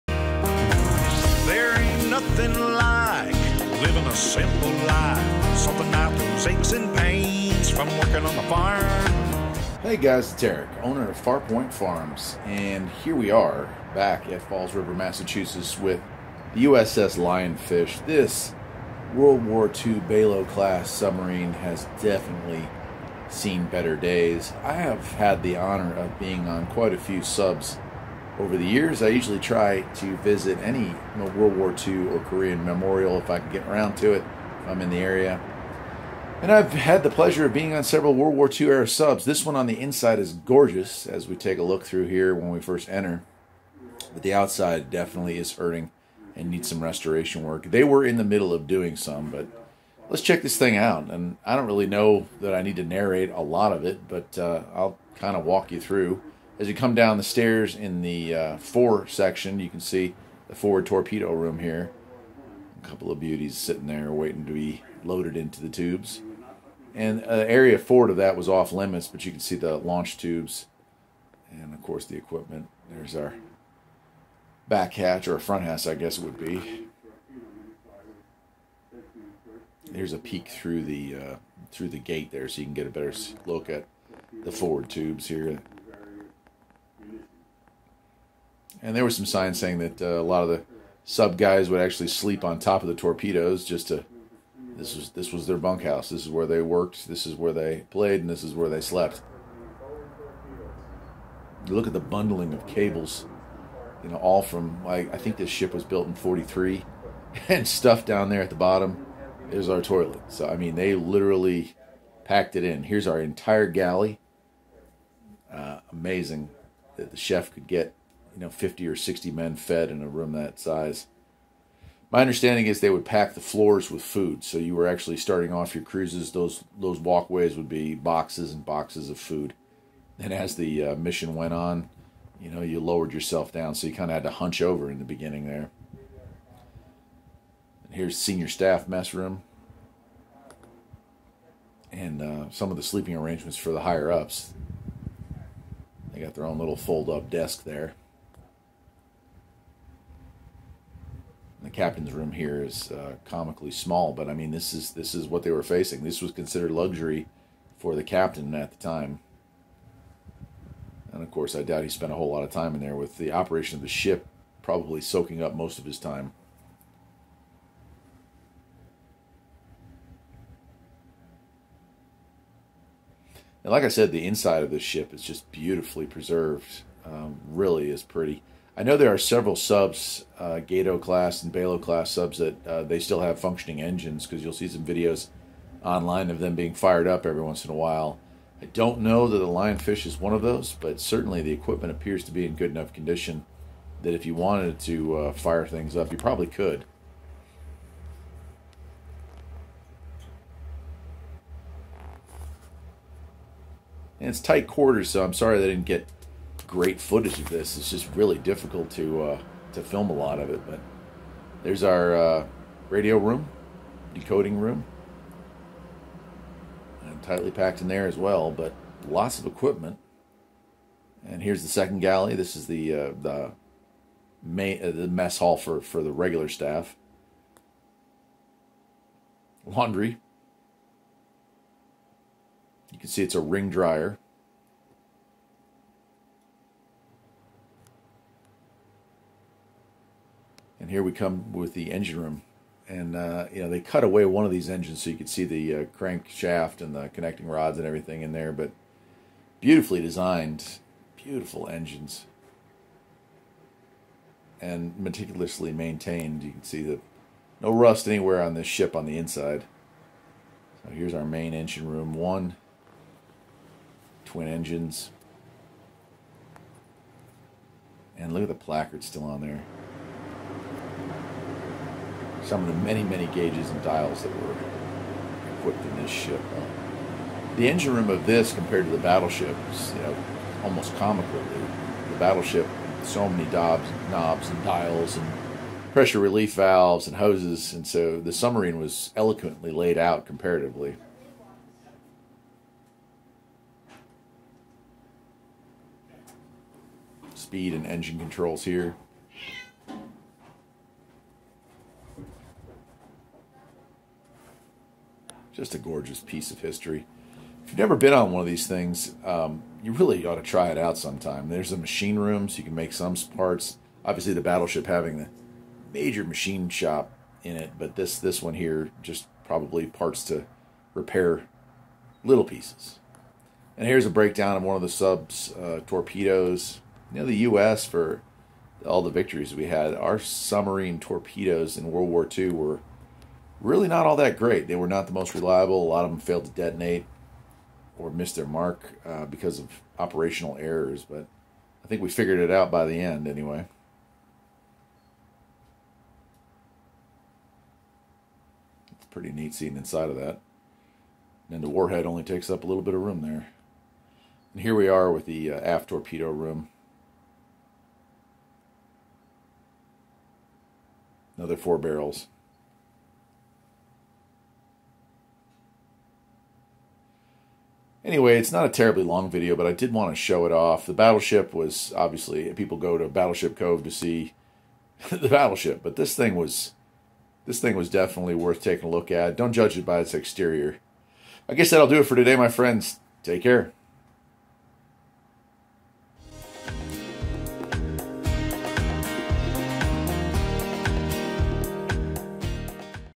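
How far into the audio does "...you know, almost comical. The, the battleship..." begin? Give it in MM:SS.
04:39.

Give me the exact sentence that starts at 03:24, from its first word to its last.
And it's tight quarters, so I'm sorry they didn't get great footage of this.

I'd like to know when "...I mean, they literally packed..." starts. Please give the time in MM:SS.
01:50.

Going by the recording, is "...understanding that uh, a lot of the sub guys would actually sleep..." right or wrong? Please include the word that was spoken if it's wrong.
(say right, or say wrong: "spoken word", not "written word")
wrong: "saying", not "understanding".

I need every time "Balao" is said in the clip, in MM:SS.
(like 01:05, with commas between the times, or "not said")
00:19, 03:01.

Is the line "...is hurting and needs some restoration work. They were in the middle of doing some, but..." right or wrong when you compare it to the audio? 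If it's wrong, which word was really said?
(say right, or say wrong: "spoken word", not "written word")
right.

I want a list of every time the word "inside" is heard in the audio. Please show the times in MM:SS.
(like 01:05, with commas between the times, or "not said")
00:39, 02:54, 04:19, 05:49.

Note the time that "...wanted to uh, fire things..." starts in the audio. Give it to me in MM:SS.
03:14.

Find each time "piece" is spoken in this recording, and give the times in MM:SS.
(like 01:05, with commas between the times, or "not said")
05:06, 05:22.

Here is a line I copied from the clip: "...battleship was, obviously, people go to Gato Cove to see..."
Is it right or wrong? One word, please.
wrong.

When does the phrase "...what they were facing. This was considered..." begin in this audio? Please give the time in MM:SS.
02:35.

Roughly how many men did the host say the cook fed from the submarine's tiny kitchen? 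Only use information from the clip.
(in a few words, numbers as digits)
50 or 60.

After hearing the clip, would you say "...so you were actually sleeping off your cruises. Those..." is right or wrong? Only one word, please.
wrong.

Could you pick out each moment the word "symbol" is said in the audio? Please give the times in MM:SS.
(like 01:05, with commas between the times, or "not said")
not said.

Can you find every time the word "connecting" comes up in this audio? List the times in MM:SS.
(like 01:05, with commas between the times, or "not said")
04:07.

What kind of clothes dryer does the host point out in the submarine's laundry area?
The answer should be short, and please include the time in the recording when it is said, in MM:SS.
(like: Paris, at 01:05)
ring dryer, at 03:53.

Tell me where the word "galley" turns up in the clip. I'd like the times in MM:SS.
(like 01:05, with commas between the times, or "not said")
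01:53, 03:41.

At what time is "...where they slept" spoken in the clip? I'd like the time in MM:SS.
01:38.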